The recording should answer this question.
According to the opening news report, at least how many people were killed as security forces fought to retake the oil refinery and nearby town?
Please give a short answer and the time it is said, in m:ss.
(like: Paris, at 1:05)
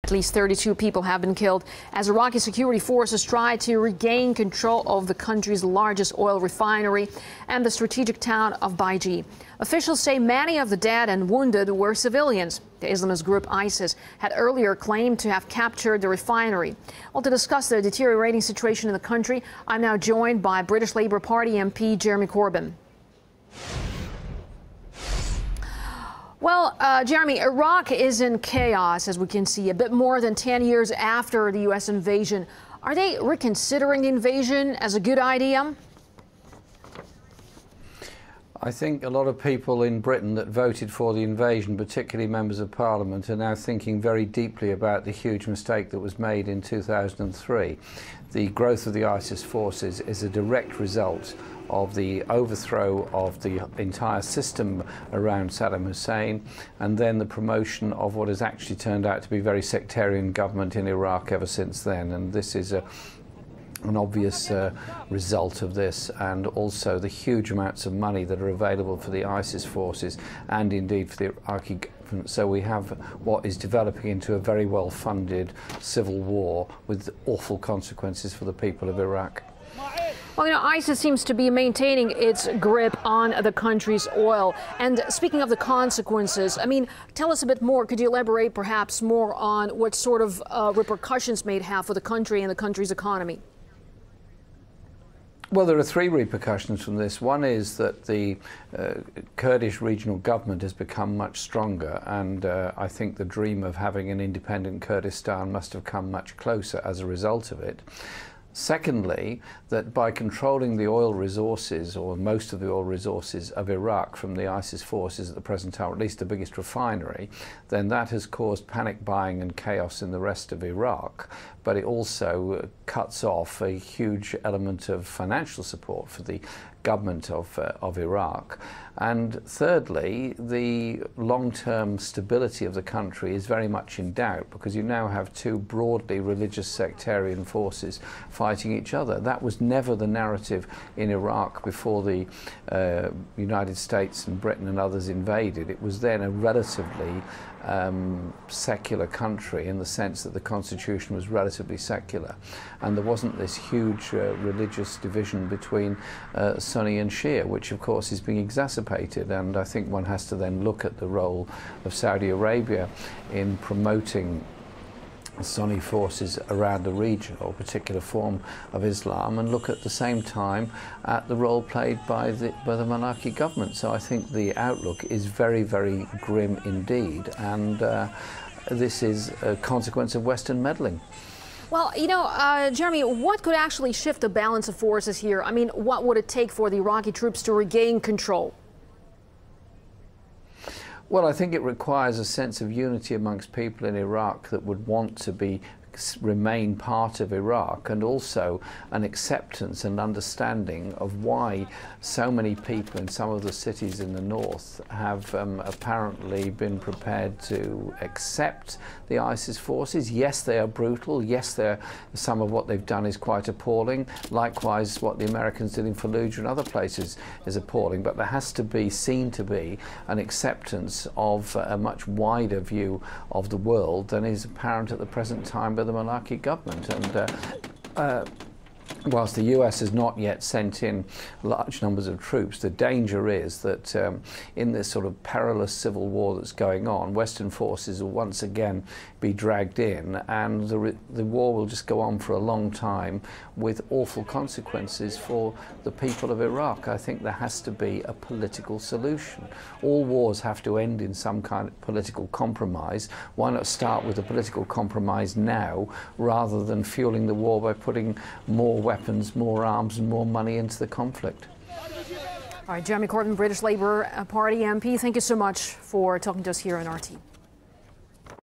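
32, at 0:00.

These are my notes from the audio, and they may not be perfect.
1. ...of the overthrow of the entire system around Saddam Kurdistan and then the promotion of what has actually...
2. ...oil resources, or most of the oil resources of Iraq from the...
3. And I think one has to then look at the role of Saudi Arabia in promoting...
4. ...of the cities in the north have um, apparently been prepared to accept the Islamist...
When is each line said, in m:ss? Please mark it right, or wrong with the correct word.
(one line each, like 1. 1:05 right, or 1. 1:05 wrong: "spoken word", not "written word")
1. 0:51 wrong: "Hussein", not "Kurdistan"
2. 1:50 right
3. 2:39 right
4. 3:23 wrong: "ISIS", not "Islamist".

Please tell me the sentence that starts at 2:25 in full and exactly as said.
It was then a relatively um, secular country in the sense that the constitution was relatively relatively secular.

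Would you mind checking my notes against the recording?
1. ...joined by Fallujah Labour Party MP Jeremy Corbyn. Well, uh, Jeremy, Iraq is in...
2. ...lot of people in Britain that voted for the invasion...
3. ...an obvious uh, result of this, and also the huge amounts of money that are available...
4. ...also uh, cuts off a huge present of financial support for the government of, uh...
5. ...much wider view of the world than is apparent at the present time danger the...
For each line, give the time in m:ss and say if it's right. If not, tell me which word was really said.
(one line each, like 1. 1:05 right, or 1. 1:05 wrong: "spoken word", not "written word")
1. 0:19 wrong: "British", not "Fallujah"
2. 0:39 right
3. 1:03 right
4. 2:01 wrong: "element", not "present"
5. 3:41 wrong: "under", not "danger".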